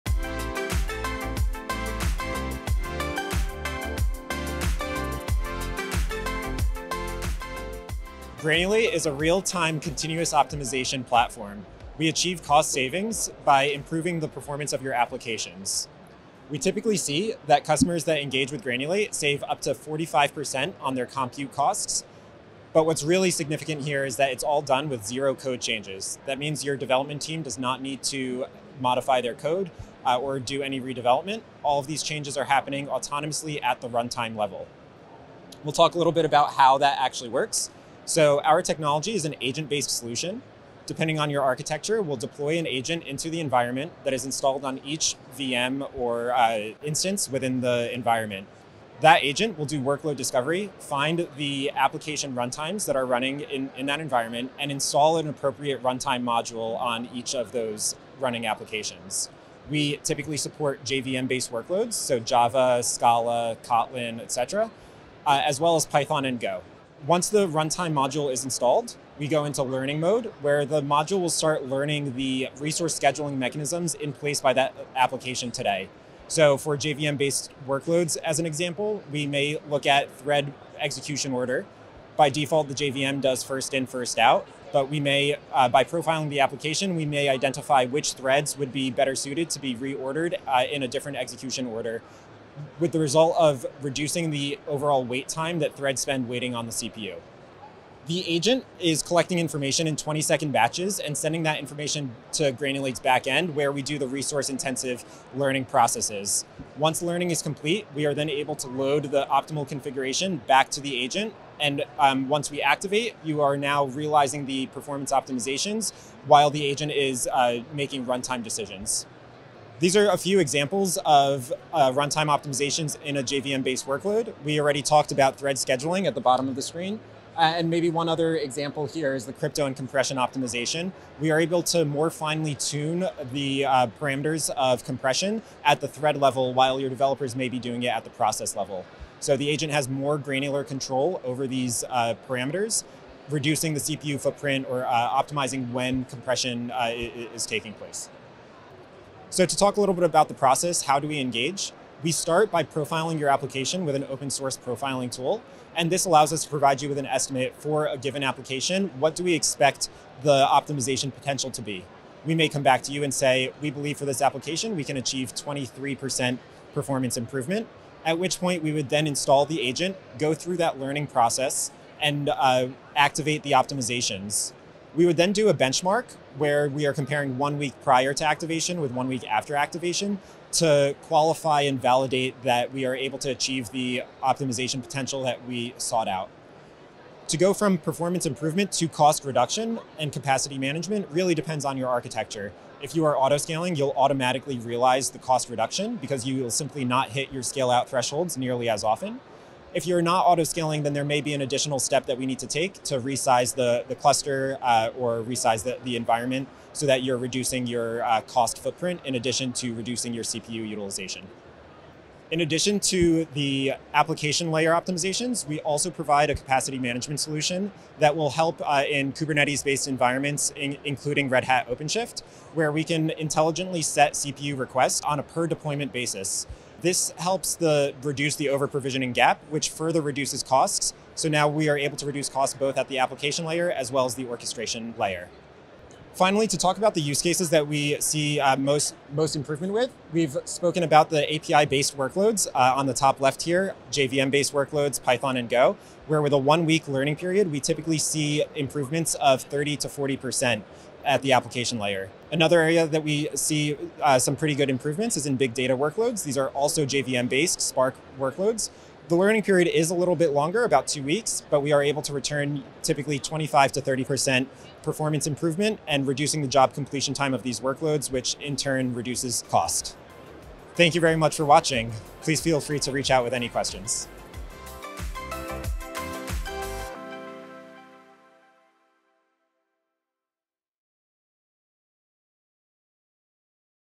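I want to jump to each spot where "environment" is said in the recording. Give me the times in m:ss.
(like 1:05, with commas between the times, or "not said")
0:43, 0:47, 0:53, 3:25, 3:39.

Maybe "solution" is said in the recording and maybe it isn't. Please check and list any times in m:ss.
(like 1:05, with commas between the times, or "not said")
0:39, 3:37.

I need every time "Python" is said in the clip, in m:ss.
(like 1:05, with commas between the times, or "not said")
1:05, 4:05.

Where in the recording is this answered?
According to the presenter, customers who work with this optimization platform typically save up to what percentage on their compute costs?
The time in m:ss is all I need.
0:19.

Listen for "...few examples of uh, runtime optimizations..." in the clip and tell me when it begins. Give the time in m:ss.
2:00.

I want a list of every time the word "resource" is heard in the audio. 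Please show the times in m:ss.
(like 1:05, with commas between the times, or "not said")
1:12, 1:44.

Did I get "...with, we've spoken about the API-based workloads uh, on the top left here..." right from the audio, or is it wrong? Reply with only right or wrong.
right.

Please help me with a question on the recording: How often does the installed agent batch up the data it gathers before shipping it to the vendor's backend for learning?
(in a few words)
20 seconds.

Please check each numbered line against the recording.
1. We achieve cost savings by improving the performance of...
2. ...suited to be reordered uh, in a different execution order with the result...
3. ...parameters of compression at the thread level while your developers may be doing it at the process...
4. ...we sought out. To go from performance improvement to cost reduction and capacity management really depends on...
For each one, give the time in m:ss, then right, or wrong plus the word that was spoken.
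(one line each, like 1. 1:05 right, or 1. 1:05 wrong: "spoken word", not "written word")
1. 0:11 right
2. 1:29 right
3. 2:13 right
4. 3:05 right.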